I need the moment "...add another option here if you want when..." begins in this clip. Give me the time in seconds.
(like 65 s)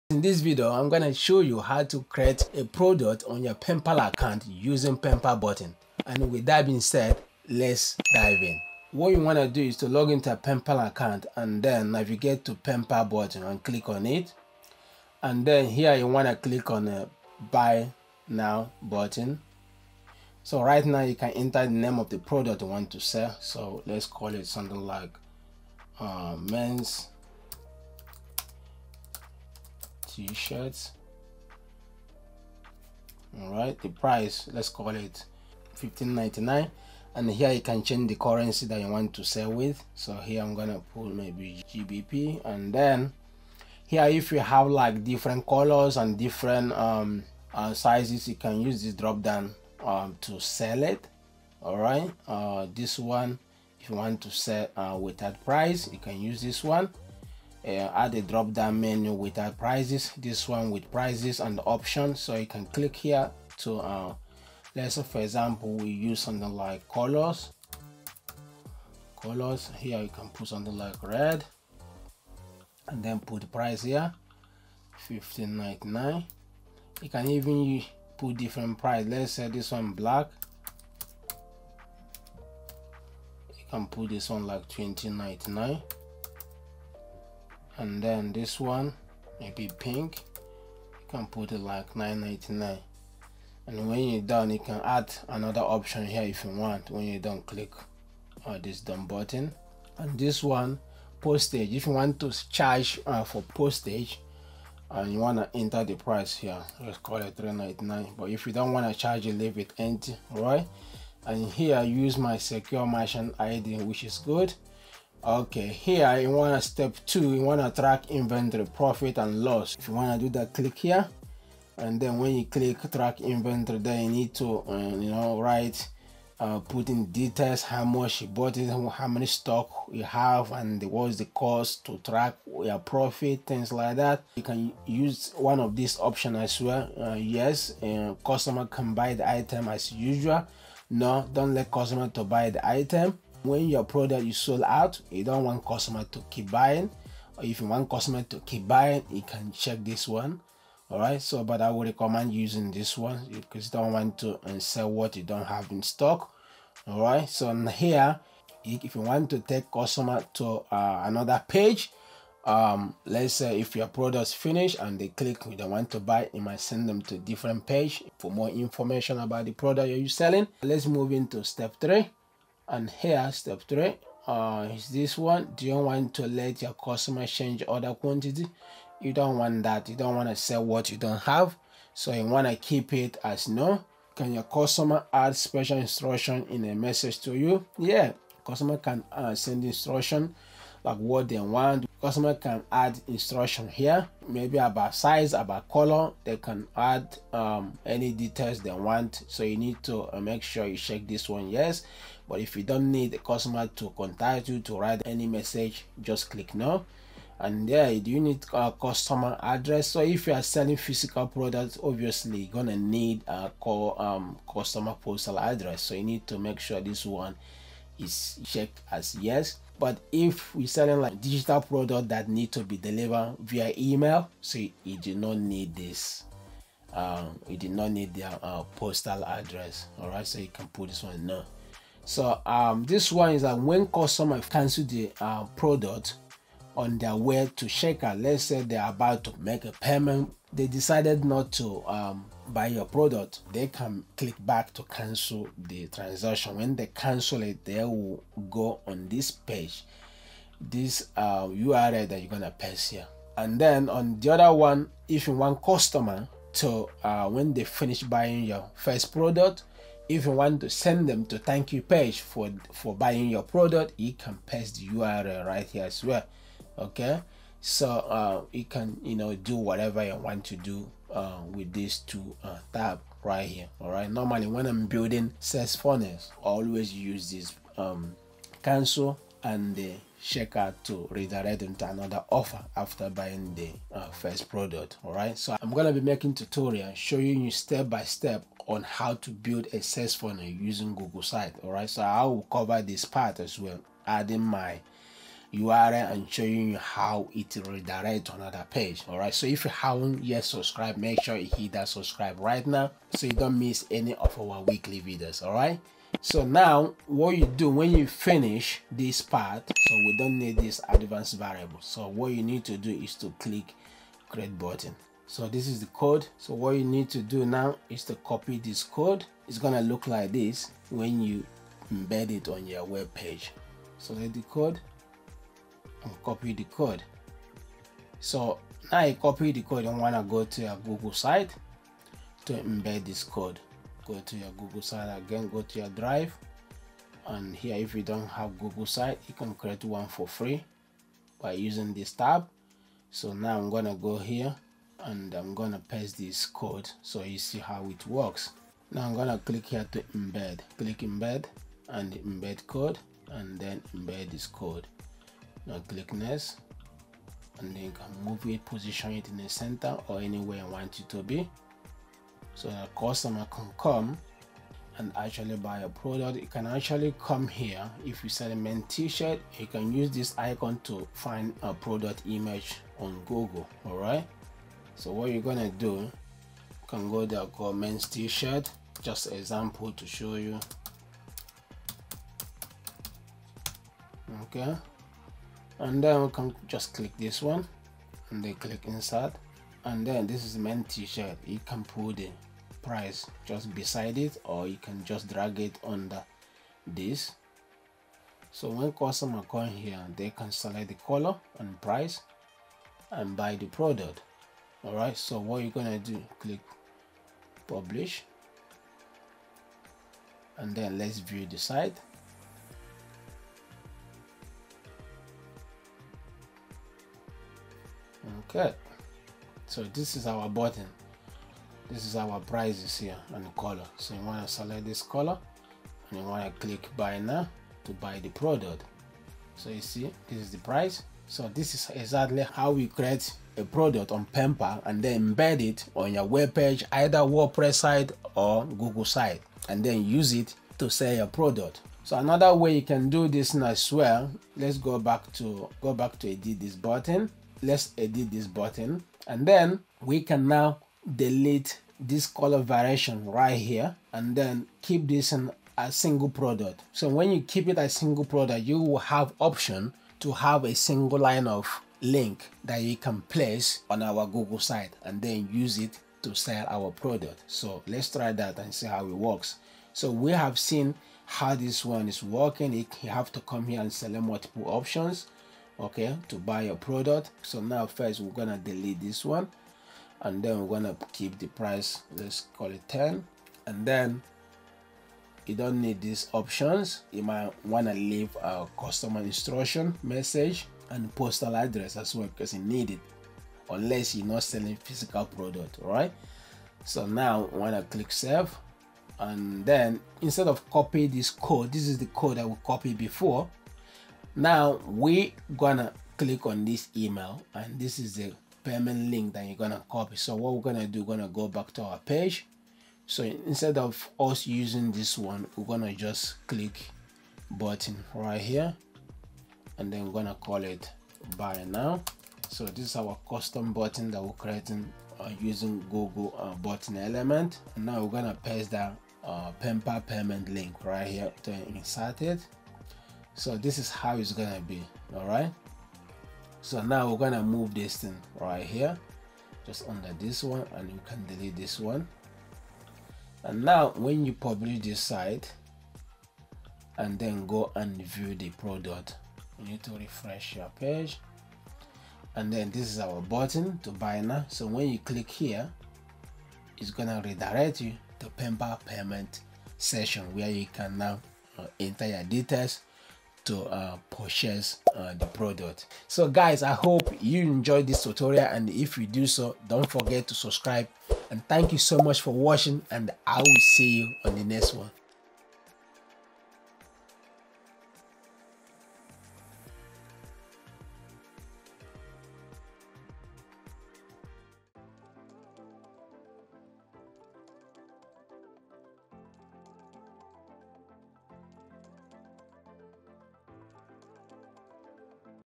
94 s.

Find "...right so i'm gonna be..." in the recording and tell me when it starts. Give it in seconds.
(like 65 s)
285 s.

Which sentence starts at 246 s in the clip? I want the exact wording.
When they cancel it, they will go on this page, this uh, URL that you're gonna paste here.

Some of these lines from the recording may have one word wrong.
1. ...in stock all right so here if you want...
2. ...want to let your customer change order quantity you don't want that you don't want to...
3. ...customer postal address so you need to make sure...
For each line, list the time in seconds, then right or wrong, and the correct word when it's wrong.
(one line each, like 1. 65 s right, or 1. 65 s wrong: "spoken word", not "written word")
1. 155 s right
2. 175 s right
3. 214 s right.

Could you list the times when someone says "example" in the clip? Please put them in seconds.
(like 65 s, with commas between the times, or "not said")
65 s, 379 s.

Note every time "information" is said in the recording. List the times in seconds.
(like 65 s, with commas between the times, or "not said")
168 s.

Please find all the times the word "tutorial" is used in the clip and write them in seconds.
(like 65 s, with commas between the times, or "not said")
286 s, 568 s.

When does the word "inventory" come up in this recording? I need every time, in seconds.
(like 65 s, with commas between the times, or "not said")
118 s, 123 s.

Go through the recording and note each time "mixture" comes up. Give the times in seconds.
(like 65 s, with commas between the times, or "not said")
not said.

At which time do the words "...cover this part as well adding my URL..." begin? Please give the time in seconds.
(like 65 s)
292 s.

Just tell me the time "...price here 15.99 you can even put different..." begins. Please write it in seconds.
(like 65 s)
73 s.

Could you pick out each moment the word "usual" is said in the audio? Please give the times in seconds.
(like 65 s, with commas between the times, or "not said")
139 s.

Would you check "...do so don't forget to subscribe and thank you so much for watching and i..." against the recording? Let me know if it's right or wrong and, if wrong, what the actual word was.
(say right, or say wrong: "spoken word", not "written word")
right.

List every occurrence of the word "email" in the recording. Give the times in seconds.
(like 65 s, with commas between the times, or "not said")
223 s, 506 s.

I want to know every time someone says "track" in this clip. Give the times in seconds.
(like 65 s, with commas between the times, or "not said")
117 s, 122 s, 132 s.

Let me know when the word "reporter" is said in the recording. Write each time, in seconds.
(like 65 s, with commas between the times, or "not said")
not said.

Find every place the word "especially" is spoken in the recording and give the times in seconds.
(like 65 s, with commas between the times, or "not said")
not said.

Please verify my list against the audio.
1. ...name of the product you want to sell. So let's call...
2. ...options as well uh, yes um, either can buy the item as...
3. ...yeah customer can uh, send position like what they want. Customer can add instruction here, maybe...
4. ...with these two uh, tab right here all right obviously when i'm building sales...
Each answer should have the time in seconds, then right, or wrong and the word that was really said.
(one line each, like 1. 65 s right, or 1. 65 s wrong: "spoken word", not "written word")
1. 21 s right
2. 135 s wrong: "customer", not "either"
3. 187 s wrong: "instruction", not "position"
4. 271 s wrong: "normally", not "obviously".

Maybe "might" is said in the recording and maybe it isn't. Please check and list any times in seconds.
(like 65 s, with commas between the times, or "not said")
166 s, 487 s.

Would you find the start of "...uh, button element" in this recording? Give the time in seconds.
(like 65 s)
526 s.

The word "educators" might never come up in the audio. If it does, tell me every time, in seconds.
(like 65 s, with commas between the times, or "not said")
not said.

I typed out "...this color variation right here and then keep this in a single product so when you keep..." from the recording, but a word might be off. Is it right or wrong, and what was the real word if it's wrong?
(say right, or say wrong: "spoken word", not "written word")
right.